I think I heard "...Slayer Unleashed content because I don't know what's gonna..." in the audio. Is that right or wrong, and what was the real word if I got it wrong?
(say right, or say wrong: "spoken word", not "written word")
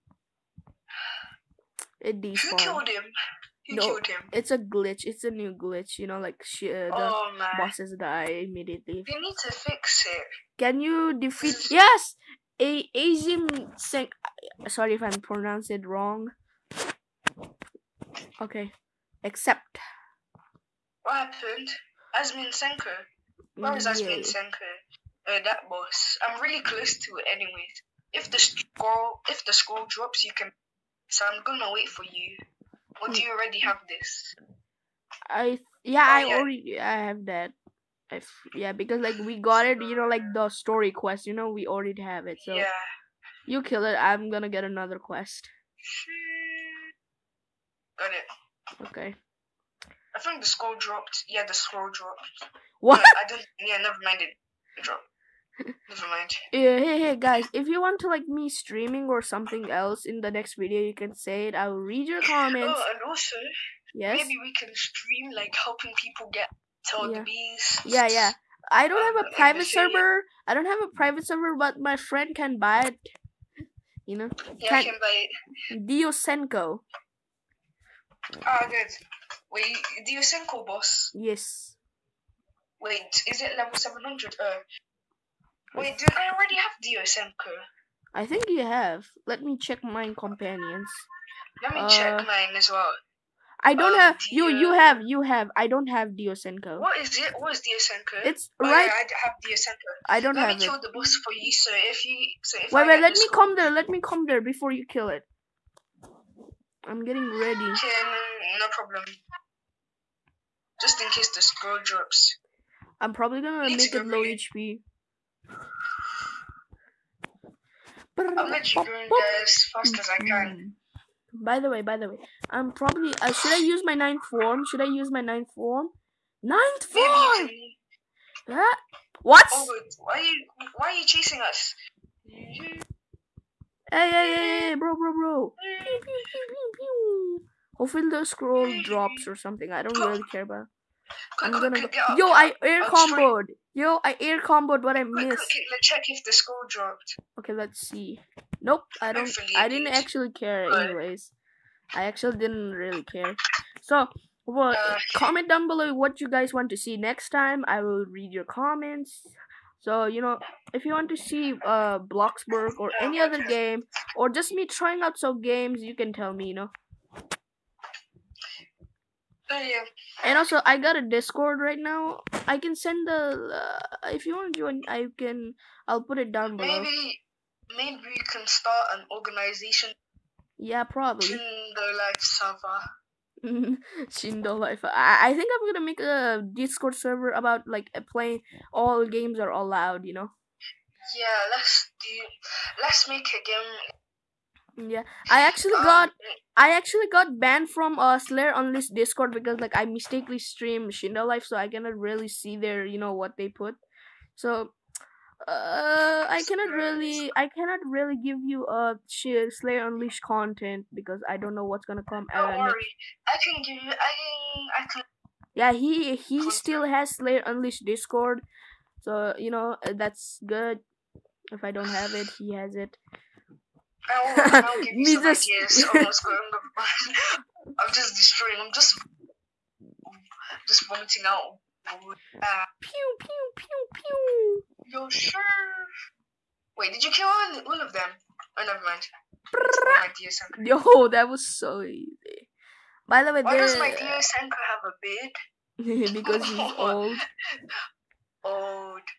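right.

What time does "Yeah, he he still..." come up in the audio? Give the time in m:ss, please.
3:35.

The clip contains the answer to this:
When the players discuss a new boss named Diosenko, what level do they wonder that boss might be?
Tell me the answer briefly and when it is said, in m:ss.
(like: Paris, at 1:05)
700, at 1:23.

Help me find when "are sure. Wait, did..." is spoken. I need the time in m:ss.
3:55.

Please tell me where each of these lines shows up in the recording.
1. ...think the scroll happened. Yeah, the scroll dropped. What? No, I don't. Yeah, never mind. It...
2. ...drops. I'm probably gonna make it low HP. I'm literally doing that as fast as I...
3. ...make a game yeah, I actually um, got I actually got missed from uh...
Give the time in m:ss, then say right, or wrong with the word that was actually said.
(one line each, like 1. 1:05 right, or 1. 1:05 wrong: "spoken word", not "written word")
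1. 0:50 wrong: "dropped", not "happened"
2. 1:51 right
3. 3:13 wrong: "banned", not "missed".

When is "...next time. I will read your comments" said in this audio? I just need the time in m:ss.
2:36.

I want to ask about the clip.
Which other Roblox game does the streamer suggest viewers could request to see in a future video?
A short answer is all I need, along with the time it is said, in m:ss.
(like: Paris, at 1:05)
Bloxburg, at 2:41.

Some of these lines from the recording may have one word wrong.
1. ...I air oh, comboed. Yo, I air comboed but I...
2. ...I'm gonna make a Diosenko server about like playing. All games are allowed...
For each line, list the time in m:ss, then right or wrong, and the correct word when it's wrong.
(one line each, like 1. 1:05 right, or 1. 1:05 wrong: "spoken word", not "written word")
1. 2:22 right
2. 3:05 wrong: "Discord", not "Diosenko".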